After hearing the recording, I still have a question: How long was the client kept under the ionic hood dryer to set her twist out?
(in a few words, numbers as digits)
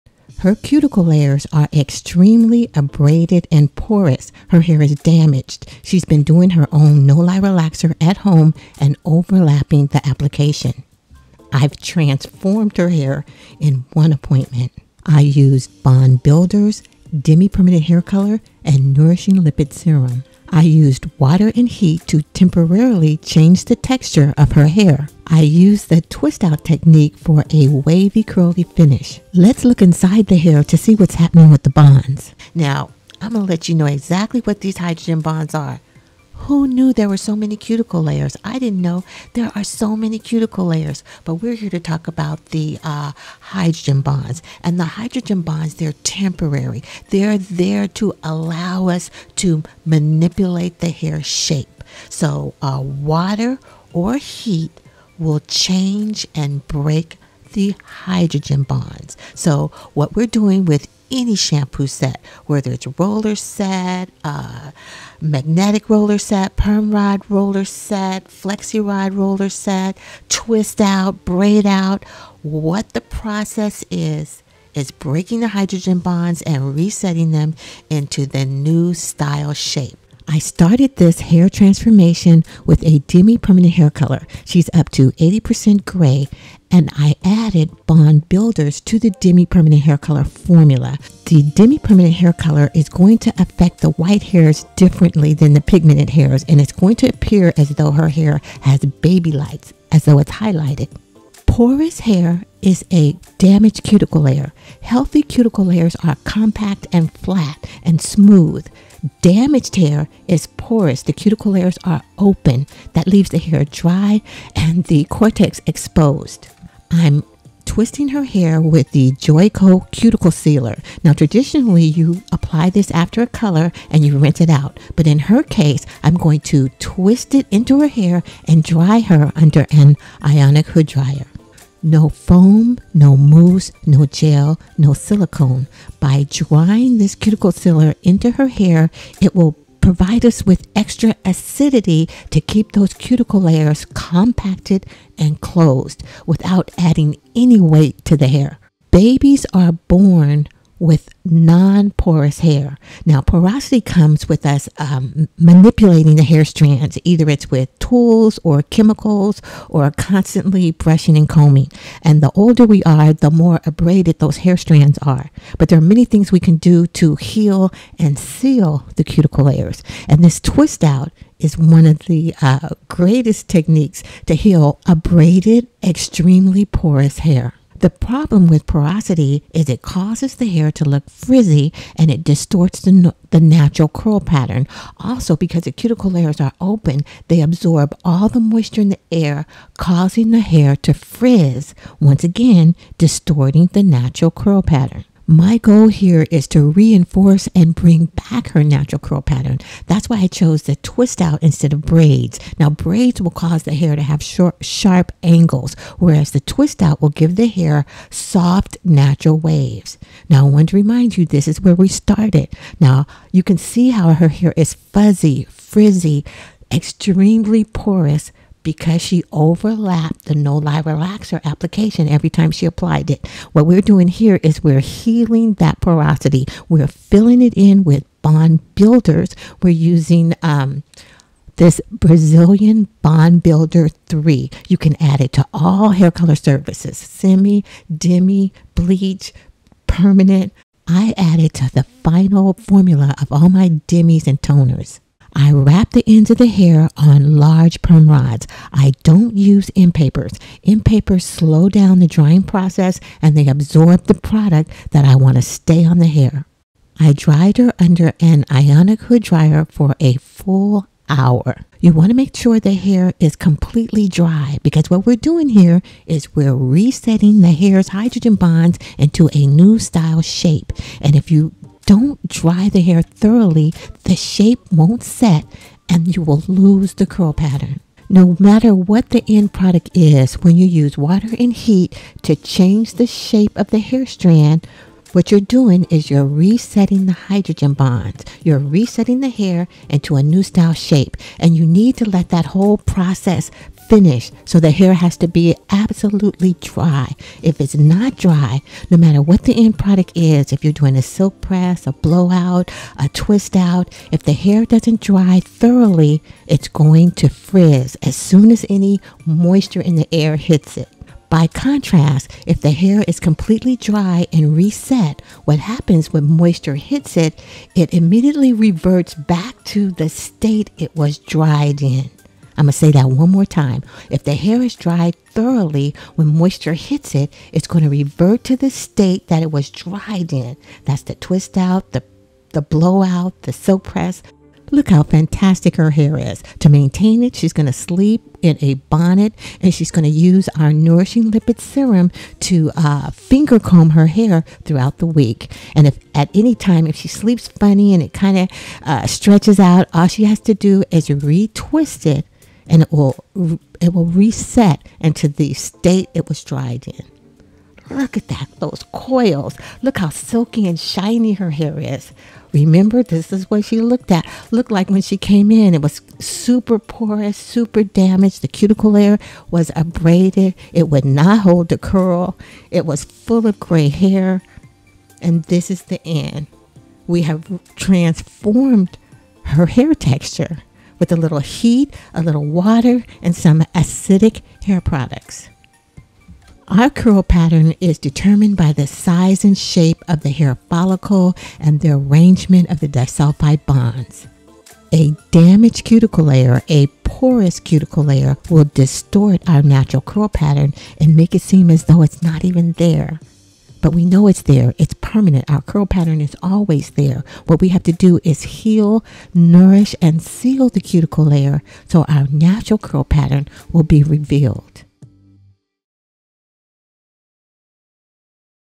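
a full hour.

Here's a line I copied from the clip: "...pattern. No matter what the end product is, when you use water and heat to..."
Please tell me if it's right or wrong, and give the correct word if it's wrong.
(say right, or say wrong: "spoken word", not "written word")
right.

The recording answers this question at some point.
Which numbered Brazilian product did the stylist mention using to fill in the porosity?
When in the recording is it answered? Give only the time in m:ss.
3:51.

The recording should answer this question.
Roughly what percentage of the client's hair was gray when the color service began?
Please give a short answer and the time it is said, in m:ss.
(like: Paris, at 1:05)
80%, at 1:25.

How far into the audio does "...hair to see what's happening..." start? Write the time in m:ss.
0:30.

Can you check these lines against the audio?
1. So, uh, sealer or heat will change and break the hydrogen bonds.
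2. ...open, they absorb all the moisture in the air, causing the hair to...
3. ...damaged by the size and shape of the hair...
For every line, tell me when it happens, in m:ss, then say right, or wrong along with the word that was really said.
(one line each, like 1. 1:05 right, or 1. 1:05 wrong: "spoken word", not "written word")
1. 0:52 wrong: "water", not "sealer"
2. 3:06 right
3. 6:27 wrong: "determined", not "damaged".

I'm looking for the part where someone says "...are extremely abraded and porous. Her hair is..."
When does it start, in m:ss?
0:01.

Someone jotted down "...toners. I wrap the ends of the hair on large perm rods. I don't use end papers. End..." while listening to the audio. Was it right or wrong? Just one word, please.
right.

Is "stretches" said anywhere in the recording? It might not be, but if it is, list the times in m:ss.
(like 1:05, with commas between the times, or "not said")
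5:49.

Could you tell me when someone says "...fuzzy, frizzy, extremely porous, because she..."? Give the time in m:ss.
3:34.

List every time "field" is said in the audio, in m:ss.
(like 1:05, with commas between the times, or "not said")
not said.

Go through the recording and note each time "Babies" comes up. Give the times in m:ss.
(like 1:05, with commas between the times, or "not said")
2:28.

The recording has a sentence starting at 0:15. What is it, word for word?
I used Bond Builders, Demi Permanent Hair Color, and Nourishing Lipid Serum.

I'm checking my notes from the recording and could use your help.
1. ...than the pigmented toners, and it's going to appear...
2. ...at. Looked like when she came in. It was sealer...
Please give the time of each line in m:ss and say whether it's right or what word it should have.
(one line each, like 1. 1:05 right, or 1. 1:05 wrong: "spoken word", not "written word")
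1. 1:35 wrong: "hairs", not "toners"
2. 6:04 wrong: "super", not "sealer".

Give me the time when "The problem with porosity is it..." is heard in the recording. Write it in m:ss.
2:57.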